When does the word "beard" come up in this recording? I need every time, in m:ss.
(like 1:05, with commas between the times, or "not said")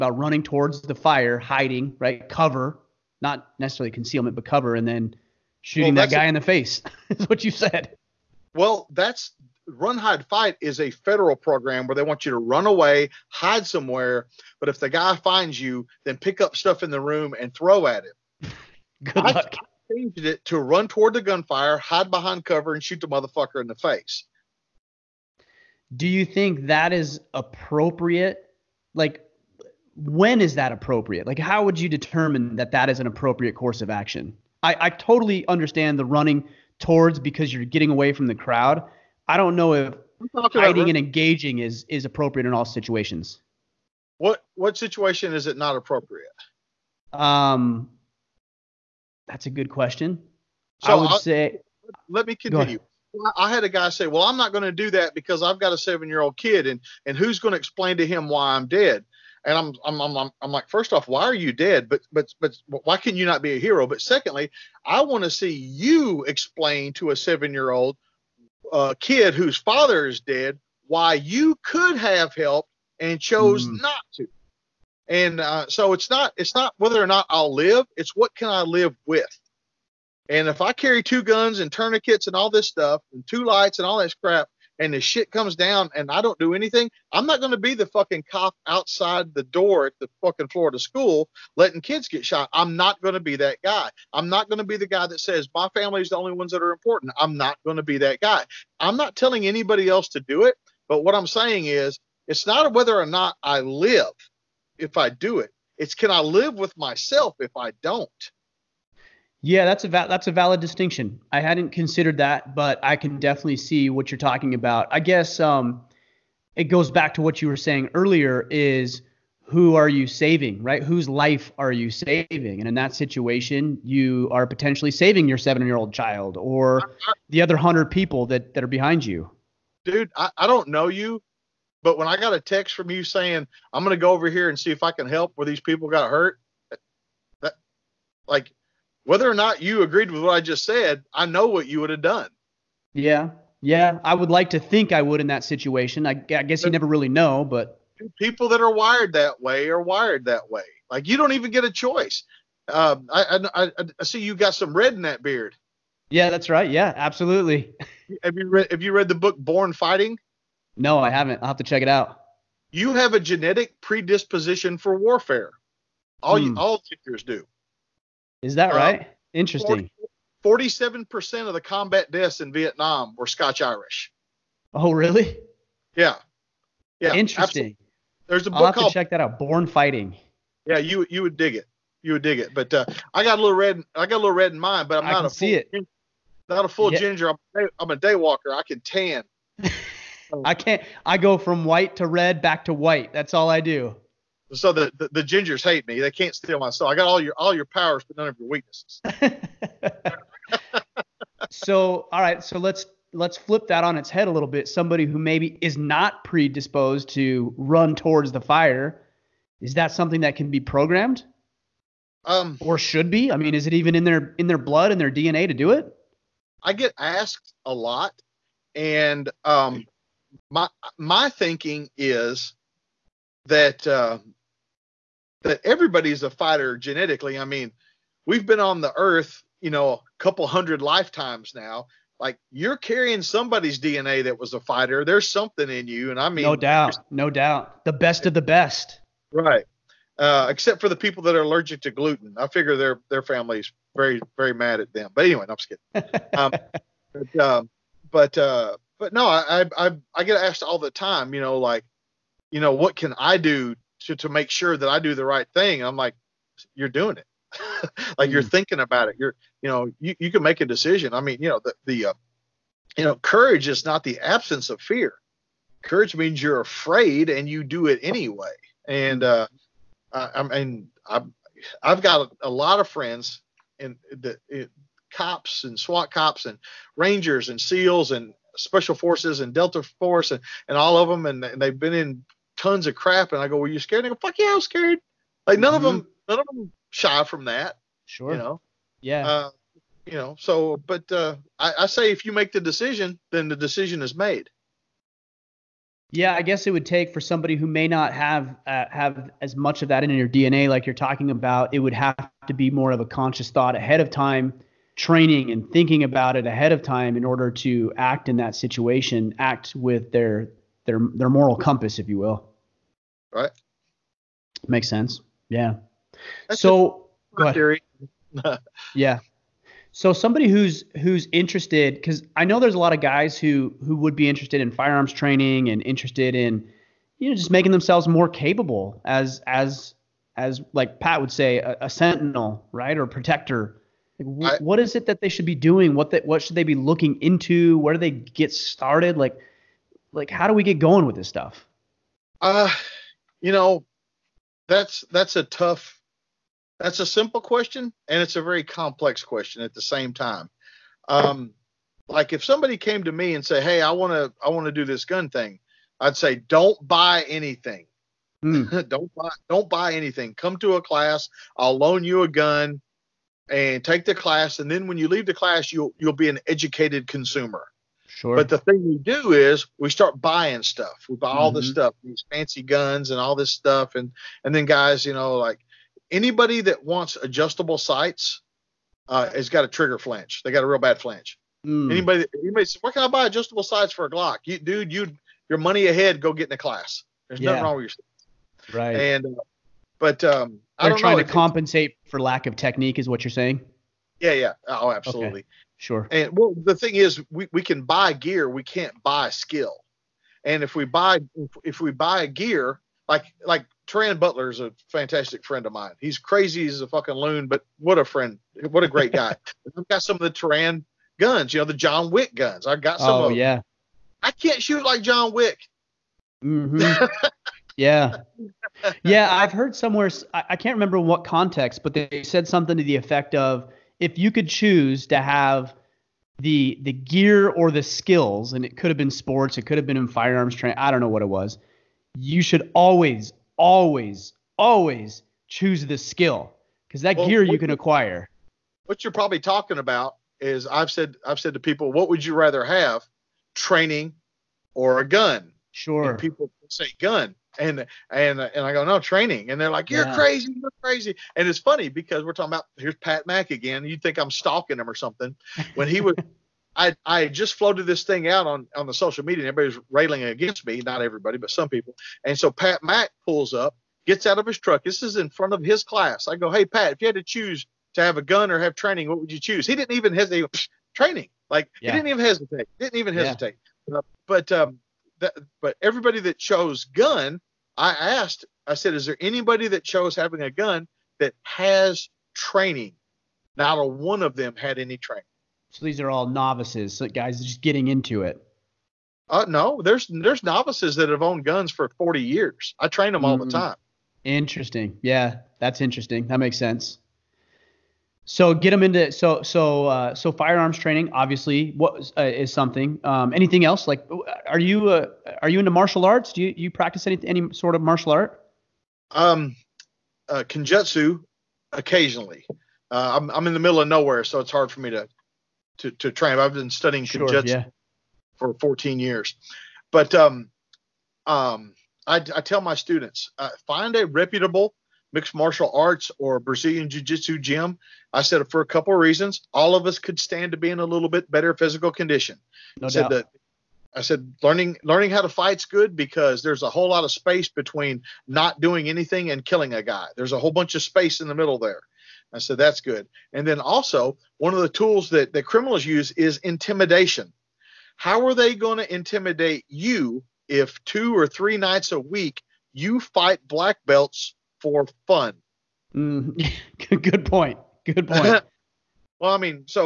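2:35.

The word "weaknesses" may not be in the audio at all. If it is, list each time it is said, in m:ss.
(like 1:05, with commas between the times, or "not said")
3:18.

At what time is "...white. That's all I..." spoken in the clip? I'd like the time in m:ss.
3:12.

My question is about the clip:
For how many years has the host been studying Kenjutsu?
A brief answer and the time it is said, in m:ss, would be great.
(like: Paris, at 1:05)
14, at 8:38.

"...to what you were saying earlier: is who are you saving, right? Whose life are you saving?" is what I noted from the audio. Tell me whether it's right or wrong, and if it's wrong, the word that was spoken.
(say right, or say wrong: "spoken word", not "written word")
right.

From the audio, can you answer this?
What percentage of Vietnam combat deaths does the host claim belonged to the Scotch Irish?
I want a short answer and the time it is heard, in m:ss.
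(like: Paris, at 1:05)
47%, at 2:50.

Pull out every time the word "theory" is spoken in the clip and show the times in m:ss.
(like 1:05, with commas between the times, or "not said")
5:17.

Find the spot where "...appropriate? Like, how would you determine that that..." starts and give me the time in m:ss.
0:30.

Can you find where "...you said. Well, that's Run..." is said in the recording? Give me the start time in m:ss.
0:07.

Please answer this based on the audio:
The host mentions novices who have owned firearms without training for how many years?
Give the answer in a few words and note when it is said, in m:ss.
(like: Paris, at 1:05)
40, at 8:11.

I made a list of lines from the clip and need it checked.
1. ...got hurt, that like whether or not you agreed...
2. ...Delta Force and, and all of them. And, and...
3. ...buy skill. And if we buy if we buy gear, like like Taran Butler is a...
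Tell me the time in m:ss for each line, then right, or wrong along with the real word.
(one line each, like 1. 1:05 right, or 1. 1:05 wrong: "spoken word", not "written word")
1. 2:15 right
2. 4:39 right
3. 6:39 right.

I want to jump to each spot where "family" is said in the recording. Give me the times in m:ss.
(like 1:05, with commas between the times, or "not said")
1:35, 4:03.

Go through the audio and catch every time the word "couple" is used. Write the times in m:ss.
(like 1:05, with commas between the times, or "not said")
3:50, 8:48.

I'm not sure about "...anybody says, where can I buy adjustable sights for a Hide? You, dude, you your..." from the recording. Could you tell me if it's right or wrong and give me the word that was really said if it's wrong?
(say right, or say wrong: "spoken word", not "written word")
wrong: "Glock", not "Hide".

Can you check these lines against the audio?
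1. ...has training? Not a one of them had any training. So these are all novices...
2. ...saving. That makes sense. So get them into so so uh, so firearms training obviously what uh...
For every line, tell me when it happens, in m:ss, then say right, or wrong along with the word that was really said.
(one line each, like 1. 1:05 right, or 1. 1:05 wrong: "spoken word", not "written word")
1. 8:01 right
2. 8:15 wrong: "interesting", not "saving".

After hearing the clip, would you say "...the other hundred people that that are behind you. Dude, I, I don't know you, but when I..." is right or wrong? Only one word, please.
right.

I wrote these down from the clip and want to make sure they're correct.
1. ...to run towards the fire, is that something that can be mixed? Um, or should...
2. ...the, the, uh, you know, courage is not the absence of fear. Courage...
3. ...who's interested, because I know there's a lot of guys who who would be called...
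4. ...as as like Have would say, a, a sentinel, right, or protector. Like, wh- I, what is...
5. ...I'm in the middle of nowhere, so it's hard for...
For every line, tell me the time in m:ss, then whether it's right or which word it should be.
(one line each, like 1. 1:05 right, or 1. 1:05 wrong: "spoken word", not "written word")
1. 3:27 wrong: "programmed", not "mixed"
2. 4:21 right
3. 5:21 wrong: "interested", not "called"
4. 5:29 wrong: "Pat", not "Have"
5. 8:33 right.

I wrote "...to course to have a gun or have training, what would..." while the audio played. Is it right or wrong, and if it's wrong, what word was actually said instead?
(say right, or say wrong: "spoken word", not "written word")
wrong: "choose", not "course".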